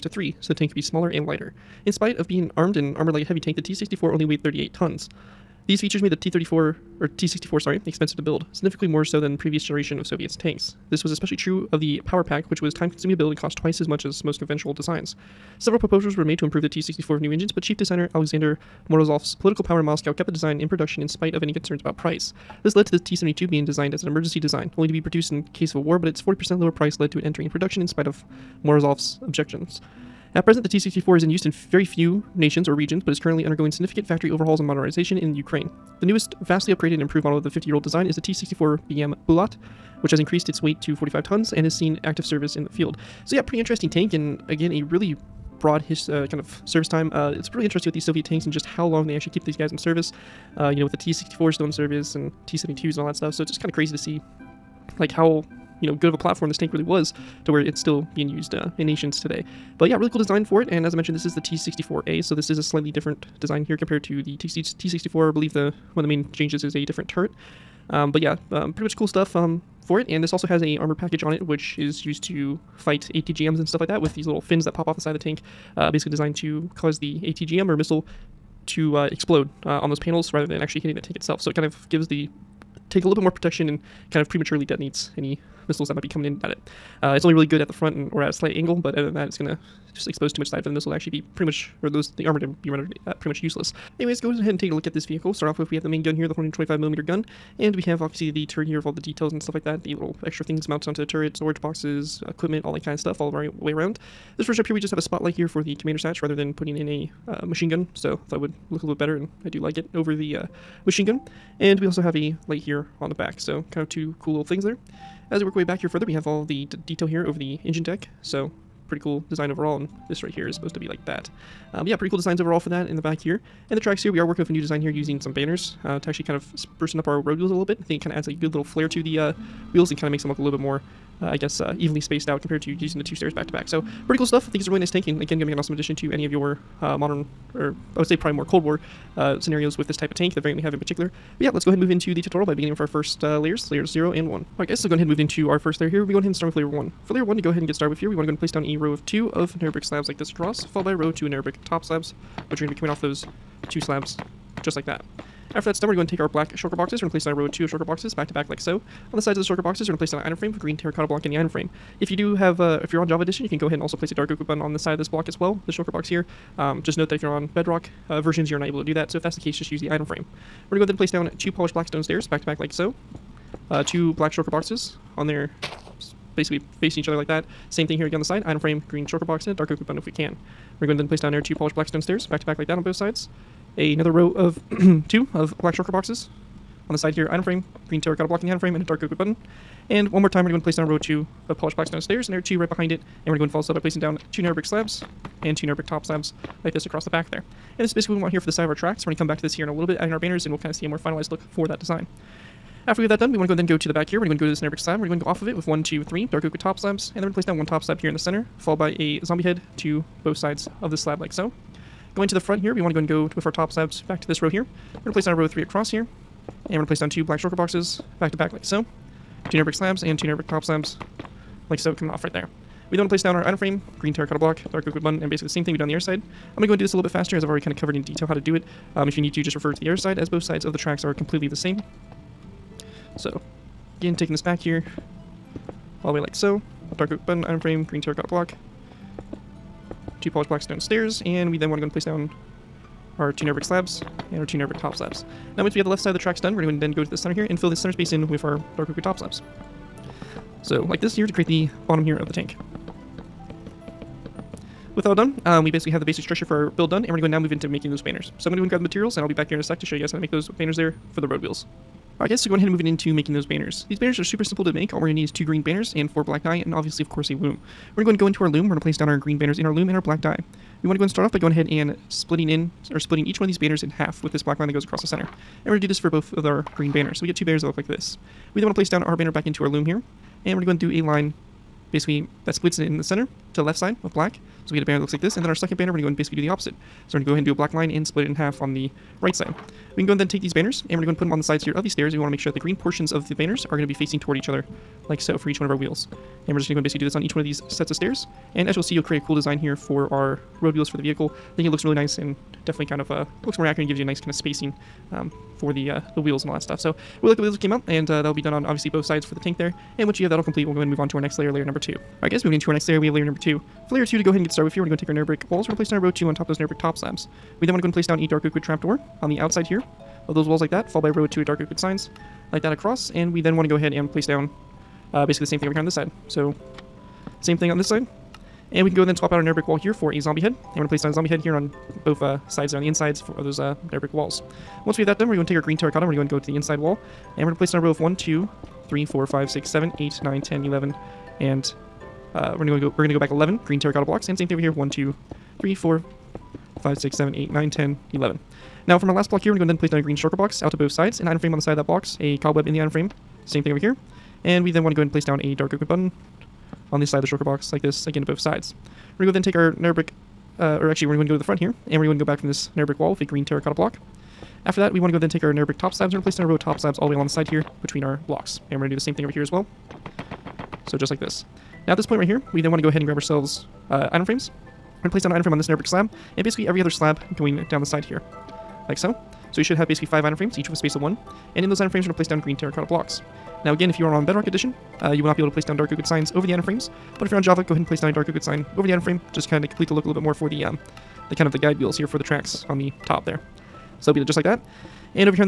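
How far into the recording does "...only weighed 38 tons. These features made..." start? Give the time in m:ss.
0:04.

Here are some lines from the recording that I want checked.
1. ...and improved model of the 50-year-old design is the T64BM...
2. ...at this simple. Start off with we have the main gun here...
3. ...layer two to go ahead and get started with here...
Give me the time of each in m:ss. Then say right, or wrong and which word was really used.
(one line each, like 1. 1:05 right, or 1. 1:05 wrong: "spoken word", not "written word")
1. 0:36 right
2. 1:34 wrong: "vehicle", not "simple"
3. 5:13 right.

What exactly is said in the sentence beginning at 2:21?
But yeah, let's go ahead and move into the tutorial by beginning with our first uh, layers, layers 0 and 1.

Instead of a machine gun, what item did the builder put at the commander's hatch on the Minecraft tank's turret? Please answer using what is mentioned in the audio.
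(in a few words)
a spotlight.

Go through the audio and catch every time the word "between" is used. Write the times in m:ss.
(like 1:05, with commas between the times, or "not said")
6:07.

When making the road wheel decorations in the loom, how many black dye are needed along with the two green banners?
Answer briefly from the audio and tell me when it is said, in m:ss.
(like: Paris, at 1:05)
4, at 4:26.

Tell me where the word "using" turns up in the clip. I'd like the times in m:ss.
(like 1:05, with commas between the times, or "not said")
2:04, 2:12.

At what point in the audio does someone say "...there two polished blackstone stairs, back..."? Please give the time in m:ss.
3:01.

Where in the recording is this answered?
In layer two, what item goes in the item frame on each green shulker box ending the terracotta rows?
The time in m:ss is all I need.
5:52.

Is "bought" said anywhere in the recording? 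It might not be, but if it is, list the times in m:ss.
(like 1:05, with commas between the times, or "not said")
not said.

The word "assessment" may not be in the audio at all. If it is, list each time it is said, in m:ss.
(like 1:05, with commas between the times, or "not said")
not said.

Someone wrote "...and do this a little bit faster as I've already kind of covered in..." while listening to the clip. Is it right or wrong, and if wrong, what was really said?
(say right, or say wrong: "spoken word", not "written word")
right.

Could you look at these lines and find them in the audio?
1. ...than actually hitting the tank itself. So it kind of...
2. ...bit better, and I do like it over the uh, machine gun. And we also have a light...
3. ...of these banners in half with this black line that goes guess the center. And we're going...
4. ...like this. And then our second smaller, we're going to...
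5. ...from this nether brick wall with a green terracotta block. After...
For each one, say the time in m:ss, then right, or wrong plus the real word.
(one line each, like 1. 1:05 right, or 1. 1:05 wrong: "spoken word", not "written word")
1. 1:20 right
2. 1:48 right
3. 4:33 wrong: "across", not "guess"
4. 4:45 wrong: "banner", not "smaller"
5. 6:02 right.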